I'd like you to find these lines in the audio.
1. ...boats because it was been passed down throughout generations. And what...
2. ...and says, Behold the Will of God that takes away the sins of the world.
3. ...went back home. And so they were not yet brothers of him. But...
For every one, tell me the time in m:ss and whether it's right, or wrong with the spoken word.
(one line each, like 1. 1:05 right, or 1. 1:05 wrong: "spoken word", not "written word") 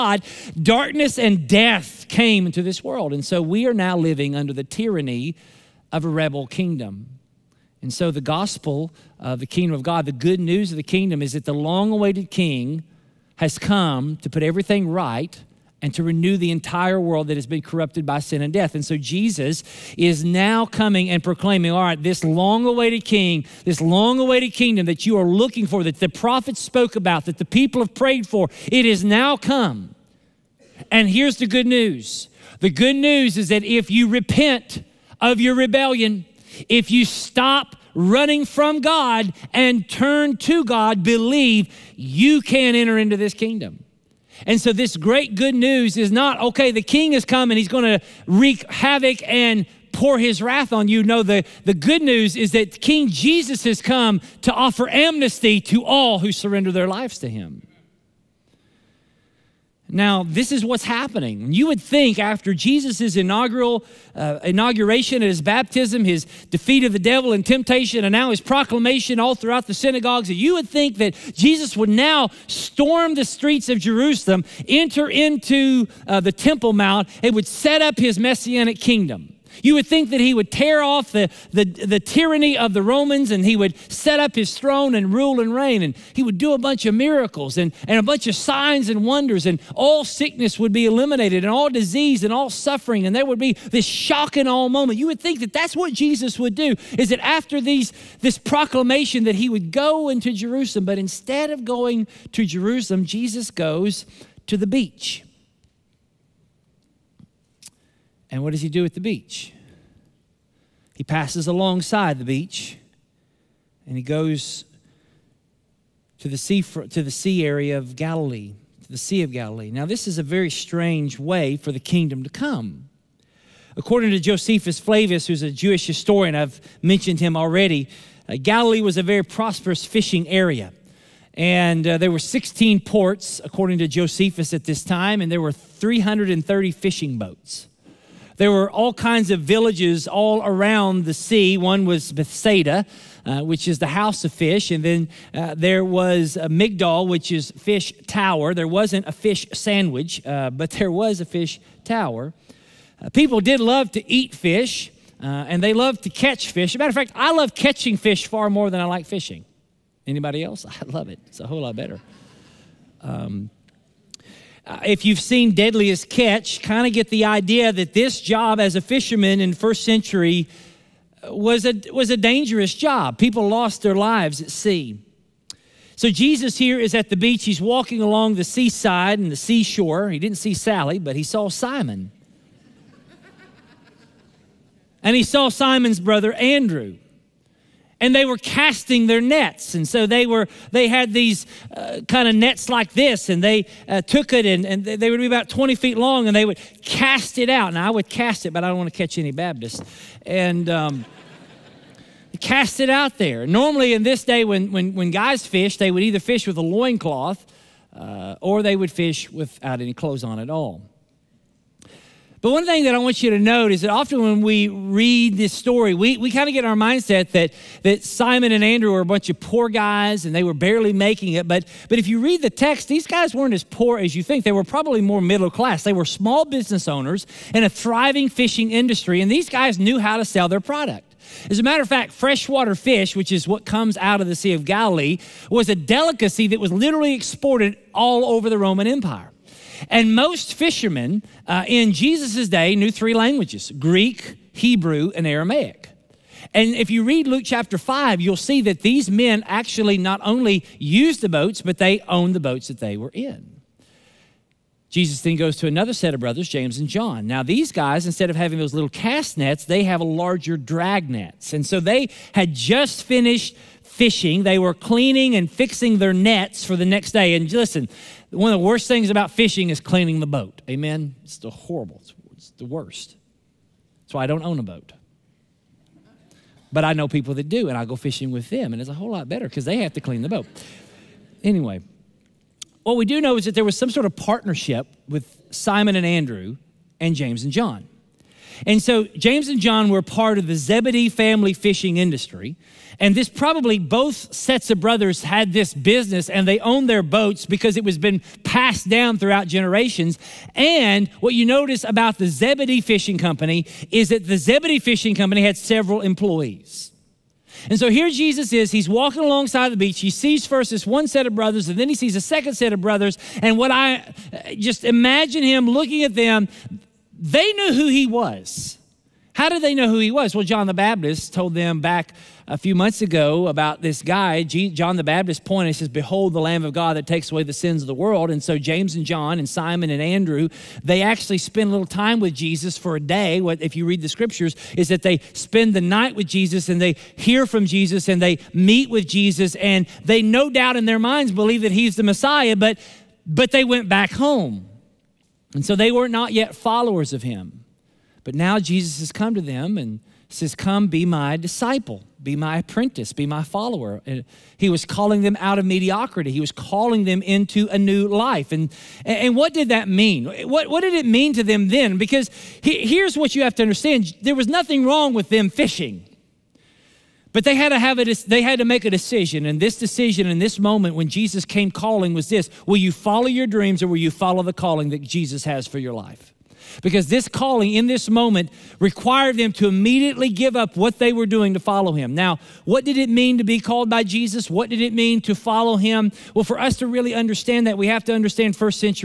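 1. 4:57 right
2. 5:25 wrong: "Lamb", not "Will"
3. 5:43 wrong: "followers", not "brothers".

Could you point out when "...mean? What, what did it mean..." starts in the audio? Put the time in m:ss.
5:59.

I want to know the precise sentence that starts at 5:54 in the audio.
And he was calling them out of mediocrity.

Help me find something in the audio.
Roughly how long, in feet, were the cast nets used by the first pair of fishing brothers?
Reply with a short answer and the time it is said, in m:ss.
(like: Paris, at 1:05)
20 feet, at 3:15.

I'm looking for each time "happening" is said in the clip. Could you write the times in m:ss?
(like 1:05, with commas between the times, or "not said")
1:00.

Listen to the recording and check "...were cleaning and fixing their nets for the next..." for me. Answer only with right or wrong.
right.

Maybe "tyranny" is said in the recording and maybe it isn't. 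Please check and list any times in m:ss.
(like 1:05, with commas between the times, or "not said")
0:04, 1:21.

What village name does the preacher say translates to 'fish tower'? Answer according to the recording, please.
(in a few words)
Migdal.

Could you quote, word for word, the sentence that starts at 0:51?
No, the, the good news is that King Jesus has come to offer amnesty to all who surrender their lives to him.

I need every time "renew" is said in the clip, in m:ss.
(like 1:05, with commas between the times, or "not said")
0:16.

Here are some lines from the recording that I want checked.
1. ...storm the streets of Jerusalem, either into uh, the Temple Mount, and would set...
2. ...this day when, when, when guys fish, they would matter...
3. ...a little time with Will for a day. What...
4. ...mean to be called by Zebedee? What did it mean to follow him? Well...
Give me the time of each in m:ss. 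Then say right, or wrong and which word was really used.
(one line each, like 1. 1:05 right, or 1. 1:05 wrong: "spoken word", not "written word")
1. 1:12 wrong: "enter", not "either"
2. 3:24 wrong: "either", not "matter"
3. 5:31 wrong: "Jesus", not "Will"
4. 6:23 wrong: "Jesus", not "Zebedee".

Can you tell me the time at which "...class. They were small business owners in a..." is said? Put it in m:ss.
3:45.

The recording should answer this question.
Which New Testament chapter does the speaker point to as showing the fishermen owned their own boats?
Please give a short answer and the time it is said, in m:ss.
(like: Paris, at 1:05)
Luke 5, at 4:07.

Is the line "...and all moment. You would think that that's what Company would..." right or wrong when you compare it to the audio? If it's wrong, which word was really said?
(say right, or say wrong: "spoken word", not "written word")
wrong: "Jesus", not "Company".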